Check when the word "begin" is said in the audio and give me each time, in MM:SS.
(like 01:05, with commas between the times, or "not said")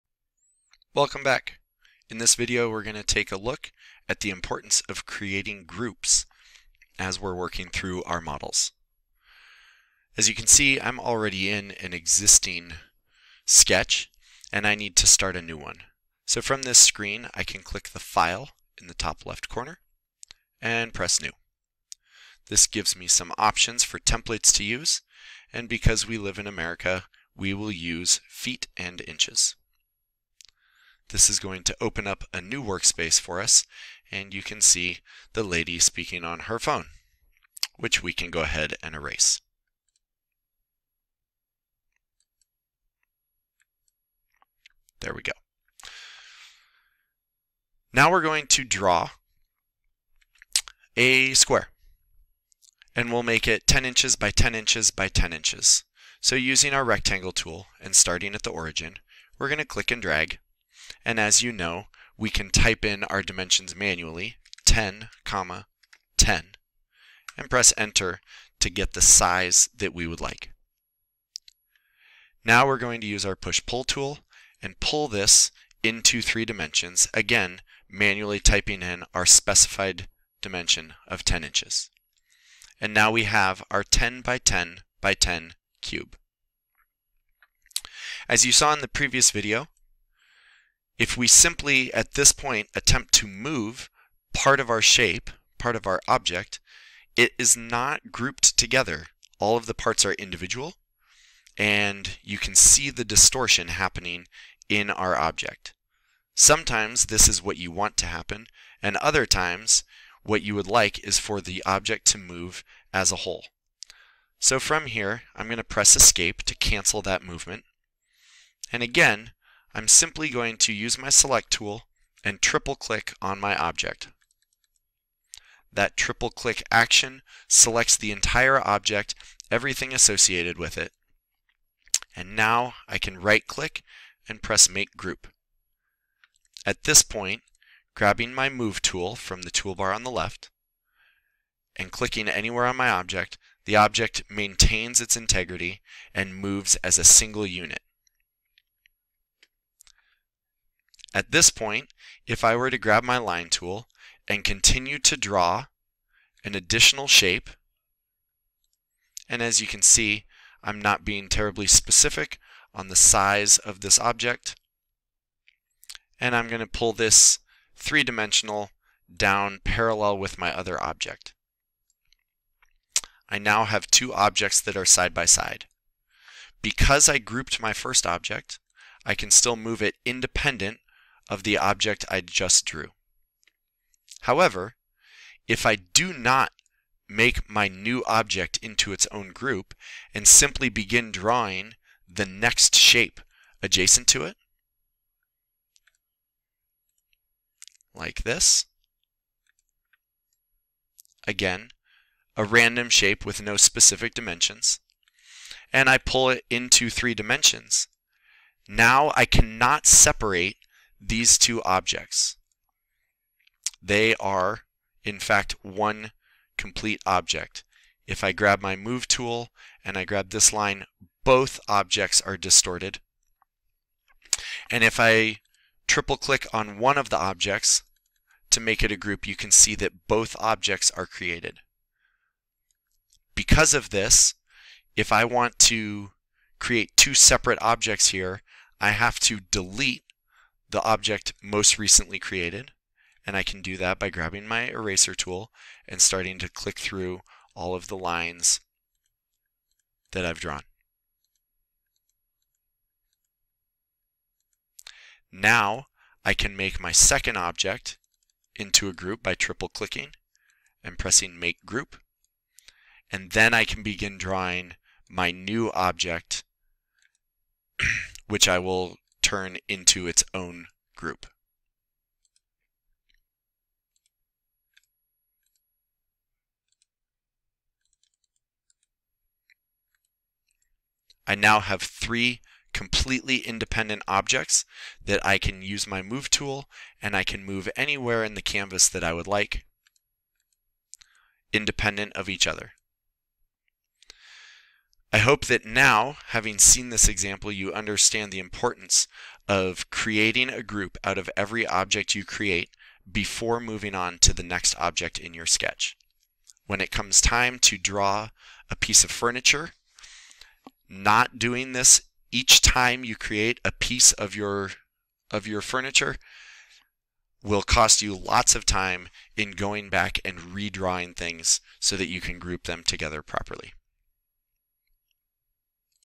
03:10, 04:23.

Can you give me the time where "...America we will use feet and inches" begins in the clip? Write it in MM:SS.
00:26.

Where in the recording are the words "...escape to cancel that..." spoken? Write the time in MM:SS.
01:55.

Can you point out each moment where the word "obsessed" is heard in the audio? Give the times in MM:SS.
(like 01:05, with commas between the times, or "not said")
not said.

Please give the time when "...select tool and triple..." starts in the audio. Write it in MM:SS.
02:01.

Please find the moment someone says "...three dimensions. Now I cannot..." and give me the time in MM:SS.
03:26.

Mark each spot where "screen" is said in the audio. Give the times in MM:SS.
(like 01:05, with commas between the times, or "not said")
00:16.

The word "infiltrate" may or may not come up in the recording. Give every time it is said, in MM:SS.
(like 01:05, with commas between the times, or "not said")
not said.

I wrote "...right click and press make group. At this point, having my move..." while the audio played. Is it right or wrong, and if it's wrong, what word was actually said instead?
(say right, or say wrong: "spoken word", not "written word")
wrong: "grabbing", not "having".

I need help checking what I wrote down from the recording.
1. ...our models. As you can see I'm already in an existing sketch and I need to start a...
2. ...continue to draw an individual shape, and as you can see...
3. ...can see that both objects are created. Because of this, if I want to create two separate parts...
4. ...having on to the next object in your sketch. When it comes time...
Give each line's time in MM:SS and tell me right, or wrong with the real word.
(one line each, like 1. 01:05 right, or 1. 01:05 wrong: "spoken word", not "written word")
1. 00:08 right
2. 02:34 wrong: "additional", not "individual"
3. 03:49 wrong: "objects", not "parts"
4. 05:03 wrong: "moving", not "having".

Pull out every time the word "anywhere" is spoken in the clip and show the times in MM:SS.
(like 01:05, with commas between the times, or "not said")
02:22, 04:47.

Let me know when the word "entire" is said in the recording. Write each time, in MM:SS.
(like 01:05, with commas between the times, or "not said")
02:08.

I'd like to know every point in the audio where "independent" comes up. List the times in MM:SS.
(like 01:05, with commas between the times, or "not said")
03:00, 04:43, 04:51.